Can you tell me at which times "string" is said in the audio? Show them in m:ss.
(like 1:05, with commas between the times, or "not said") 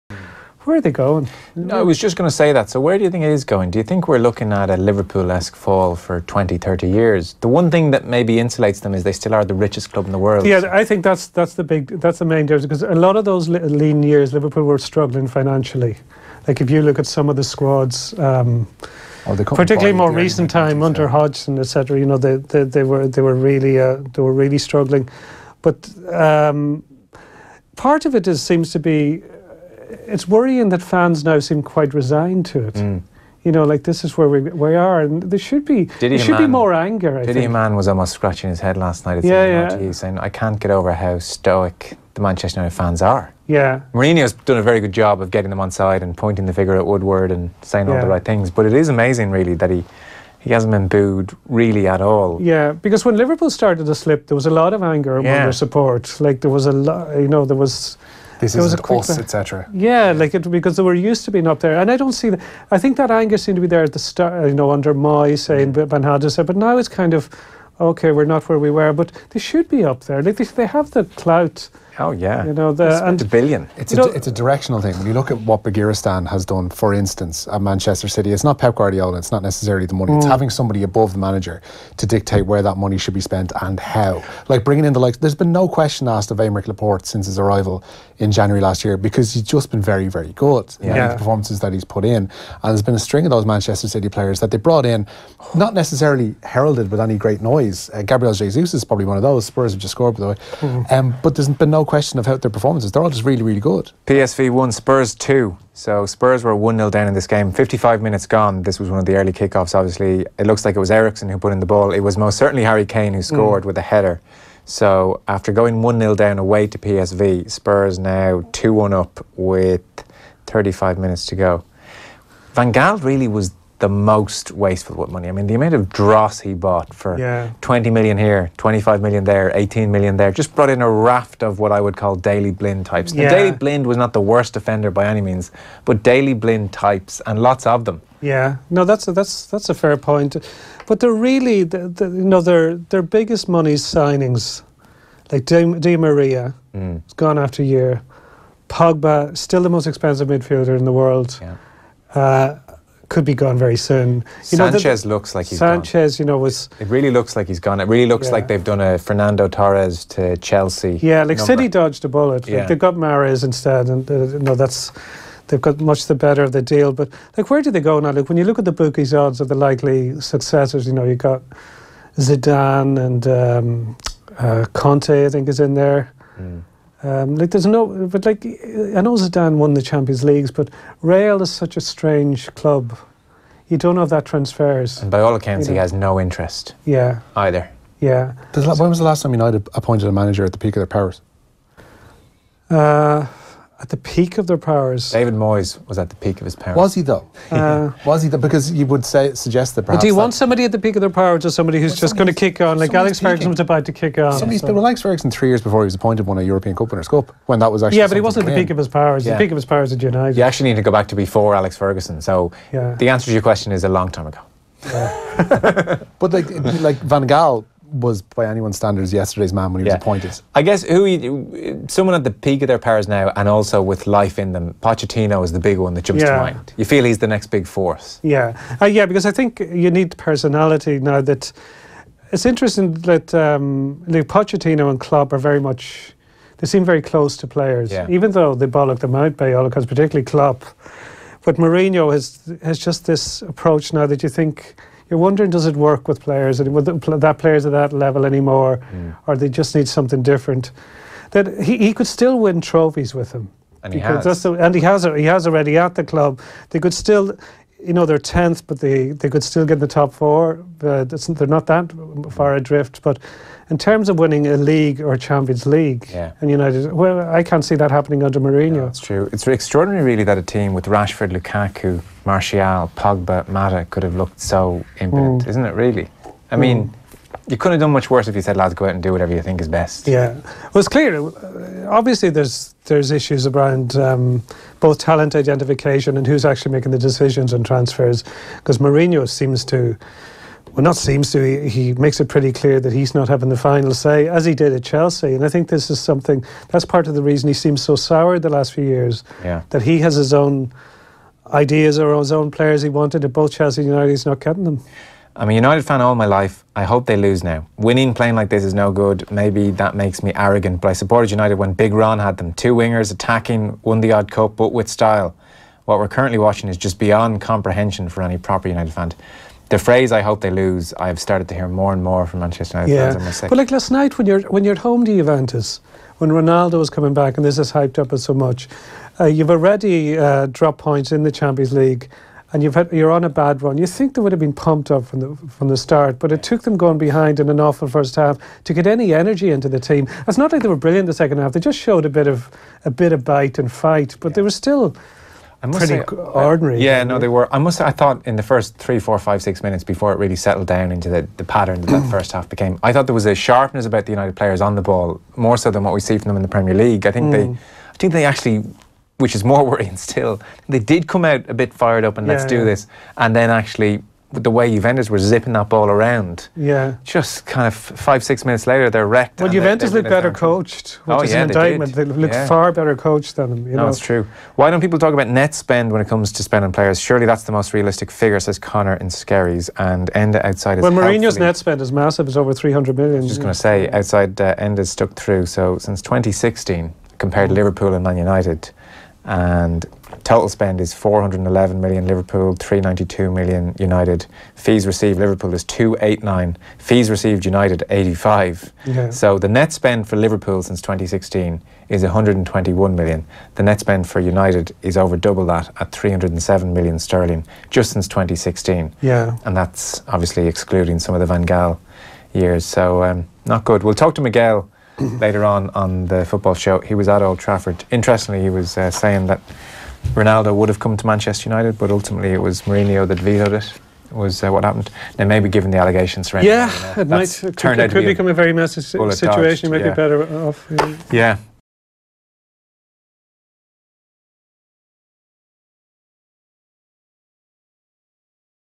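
1:32.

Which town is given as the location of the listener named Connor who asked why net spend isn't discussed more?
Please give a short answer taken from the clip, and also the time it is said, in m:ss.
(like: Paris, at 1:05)
Skerries, at 6:19.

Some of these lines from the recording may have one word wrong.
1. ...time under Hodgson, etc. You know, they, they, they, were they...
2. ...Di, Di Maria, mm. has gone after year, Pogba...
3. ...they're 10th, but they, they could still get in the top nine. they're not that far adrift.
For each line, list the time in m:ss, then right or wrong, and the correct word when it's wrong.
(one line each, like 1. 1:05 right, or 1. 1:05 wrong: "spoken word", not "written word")
1. 0:20 right
2. 2:25 right
3. 4:18 wrong: "four", not "nine".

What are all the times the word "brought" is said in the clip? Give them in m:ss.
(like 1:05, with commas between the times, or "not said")
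1:34, 2:10.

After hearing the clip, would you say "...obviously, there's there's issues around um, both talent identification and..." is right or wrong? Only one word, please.
right.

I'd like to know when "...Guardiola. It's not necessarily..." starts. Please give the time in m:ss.
1:18.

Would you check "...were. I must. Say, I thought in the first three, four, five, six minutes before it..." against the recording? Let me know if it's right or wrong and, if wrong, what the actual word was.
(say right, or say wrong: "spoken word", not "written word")
right.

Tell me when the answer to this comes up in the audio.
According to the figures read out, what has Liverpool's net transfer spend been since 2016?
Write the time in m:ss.
6:42.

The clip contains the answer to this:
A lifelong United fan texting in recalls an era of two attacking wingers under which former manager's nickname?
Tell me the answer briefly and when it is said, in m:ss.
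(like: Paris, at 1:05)
Big Ron, at 5:11.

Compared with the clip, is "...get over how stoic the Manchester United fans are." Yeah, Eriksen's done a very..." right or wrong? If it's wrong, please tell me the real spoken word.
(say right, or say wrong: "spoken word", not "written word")
wrong: "Mourinho", not "Eriksen".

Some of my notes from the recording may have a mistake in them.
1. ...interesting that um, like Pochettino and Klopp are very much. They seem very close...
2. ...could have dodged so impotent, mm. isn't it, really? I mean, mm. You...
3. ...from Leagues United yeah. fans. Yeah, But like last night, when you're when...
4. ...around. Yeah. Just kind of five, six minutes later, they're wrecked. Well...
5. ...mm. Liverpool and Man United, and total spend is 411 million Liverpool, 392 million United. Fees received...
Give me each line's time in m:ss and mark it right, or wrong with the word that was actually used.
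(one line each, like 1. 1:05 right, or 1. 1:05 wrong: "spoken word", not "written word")
1. 3:52 right
2. 4:33 wrong: "looked", not "dodged"
3. 5:22 wrong: "Manchester", not "Leagues"
4. 6:05 right
5. 6:27 right.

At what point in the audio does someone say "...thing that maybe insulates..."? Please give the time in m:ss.
0:07.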